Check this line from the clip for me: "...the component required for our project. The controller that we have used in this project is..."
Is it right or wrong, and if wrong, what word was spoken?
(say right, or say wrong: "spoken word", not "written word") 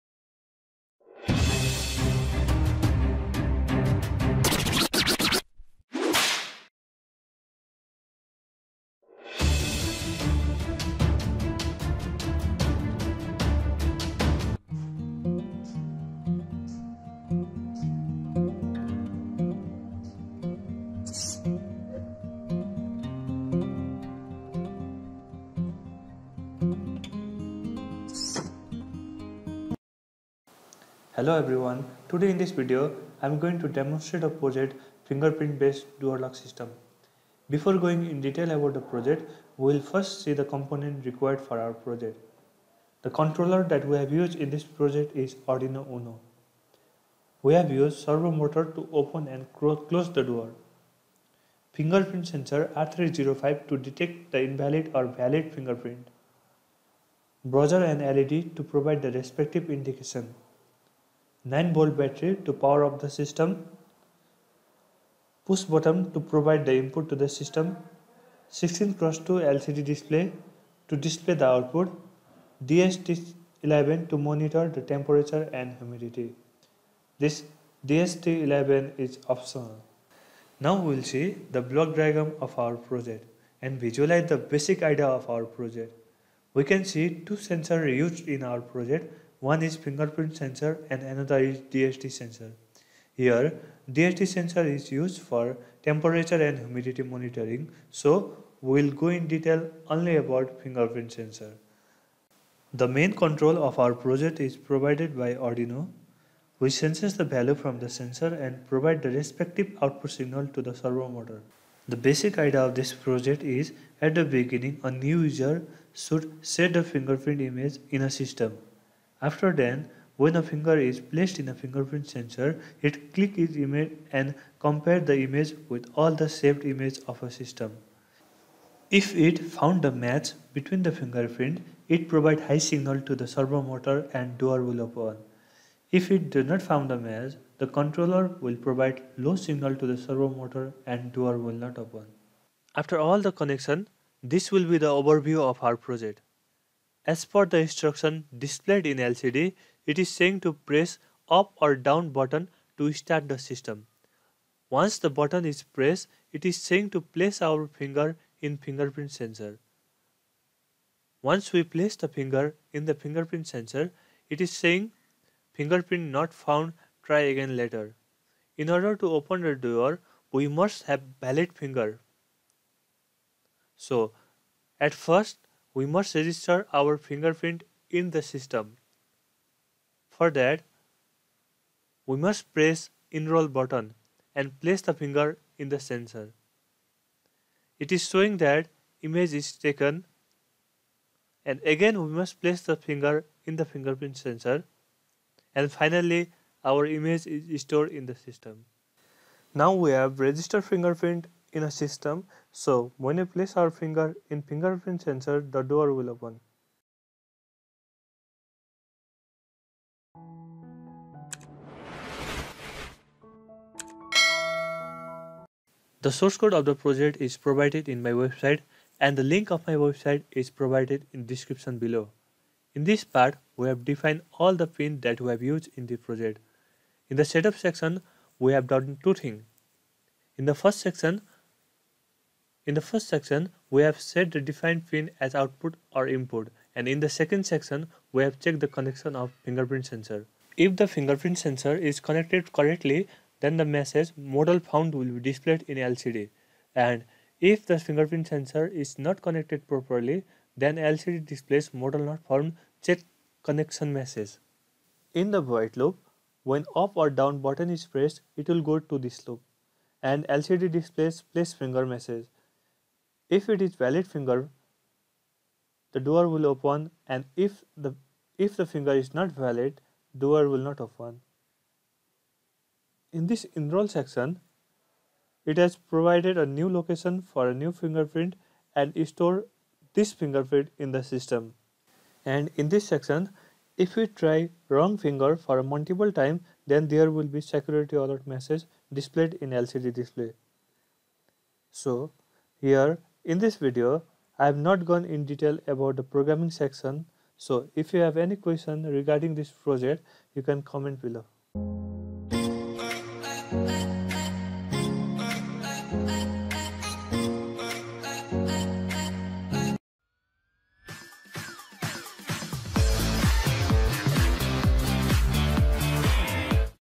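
right.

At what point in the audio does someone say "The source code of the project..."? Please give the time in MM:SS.
03:36.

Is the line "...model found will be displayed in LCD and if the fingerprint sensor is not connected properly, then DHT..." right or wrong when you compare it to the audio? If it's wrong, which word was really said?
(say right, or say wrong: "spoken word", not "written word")
wrong: "LCD", not "DHT".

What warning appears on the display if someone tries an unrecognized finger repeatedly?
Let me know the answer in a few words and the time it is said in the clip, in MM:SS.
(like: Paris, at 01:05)
Security alert, at 04:47.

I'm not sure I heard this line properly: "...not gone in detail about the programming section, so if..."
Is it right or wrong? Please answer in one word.
right.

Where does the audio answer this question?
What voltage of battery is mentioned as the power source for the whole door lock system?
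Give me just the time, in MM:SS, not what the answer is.
01:01.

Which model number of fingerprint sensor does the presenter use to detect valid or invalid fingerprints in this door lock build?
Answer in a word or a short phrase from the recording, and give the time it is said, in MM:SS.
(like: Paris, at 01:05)
R305, at 00:52.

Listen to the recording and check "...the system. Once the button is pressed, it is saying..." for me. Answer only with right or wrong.
right.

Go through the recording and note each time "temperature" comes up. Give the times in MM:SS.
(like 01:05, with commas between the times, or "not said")
01:14, 01:35.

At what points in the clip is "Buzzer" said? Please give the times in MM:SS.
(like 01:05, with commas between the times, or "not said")
00:57.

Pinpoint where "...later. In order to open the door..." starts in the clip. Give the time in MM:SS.
02:47.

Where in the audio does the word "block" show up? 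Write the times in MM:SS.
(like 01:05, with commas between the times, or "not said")
01:21.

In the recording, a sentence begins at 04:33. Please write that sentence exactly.
In this enroll section, it has provided a new location for a new fingerprint and store this fingerprint in the system.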